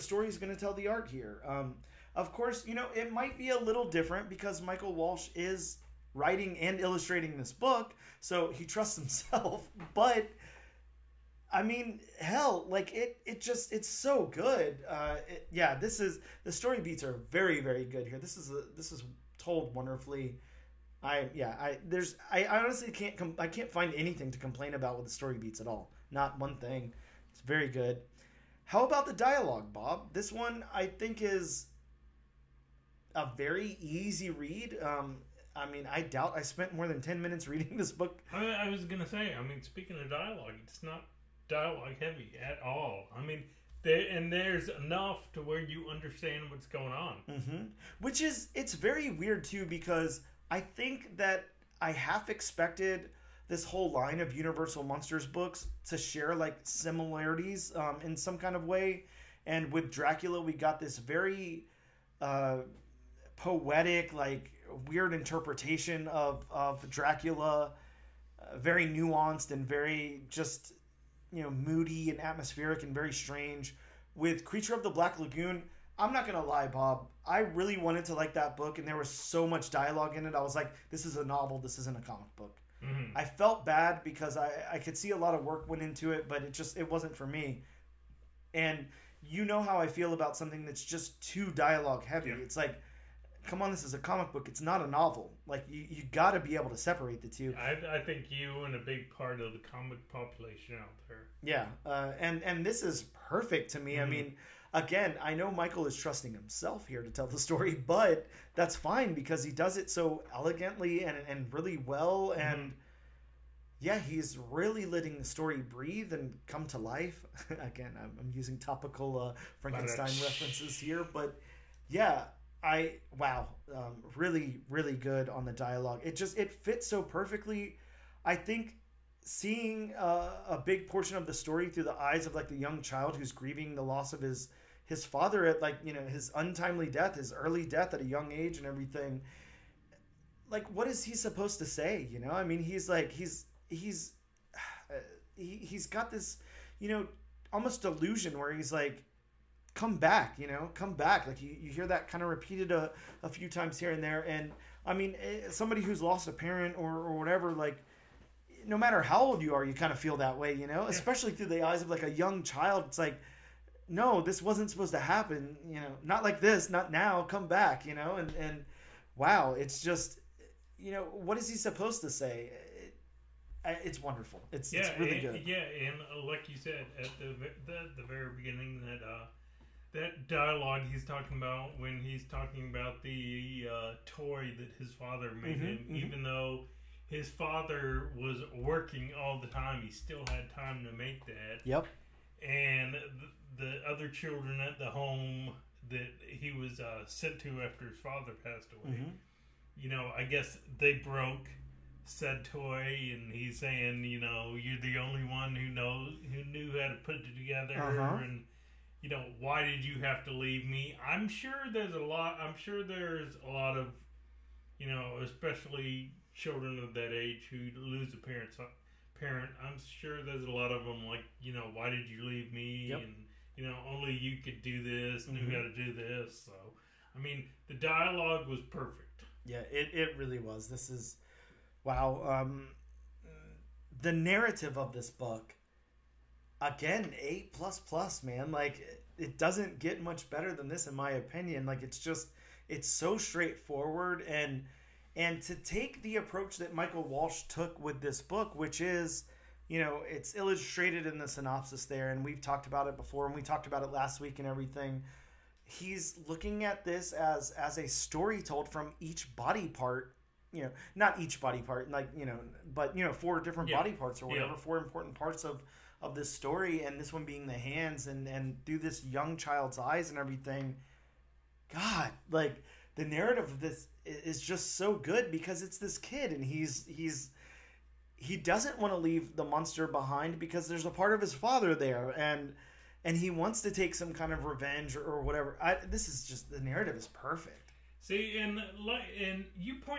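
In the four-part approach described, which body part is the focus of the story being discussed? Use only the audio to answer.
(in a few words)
The hands.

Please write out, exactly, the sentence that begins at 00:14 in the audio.
Uh, it, yeah, this is the story beats are very very good here.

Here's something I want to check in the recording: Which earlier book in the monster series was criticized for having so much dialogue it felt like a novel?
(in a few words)
Creature of the Black Lagoon.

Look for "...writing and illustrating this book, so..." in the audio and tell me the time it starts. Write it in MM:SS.
00:06.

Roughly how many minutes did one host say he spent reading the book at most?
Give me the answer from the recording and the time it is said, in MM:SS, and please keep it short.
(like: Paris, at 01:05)
10, at 00:37.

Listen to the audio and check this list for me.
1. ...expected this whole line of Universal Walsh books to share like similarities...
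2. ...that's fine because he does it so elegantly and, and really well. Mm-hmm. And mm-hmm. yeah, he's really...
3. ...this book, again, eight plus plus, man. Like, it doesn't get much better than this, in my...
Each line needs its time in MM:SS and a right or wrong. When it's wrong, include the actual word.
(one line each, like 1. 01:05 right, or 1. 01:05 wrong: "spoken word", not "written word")
1. 00:52 wrong: "Monsters", not "Walsh"
2. 01:48 right
3. 03:54 right.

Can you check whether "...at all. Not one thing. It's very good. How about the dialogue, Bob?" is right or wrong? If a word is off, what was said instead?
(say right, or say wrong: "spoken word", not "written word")
right.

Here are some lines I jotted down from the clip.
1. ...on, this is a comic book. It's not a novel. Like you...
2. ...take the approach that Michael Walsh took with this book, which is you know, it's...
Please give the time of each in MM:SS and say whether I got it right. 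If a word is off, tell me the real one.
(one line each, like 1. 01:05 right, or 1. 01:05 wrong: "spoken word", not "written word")
1. 01:33 right
2. 04:05 right.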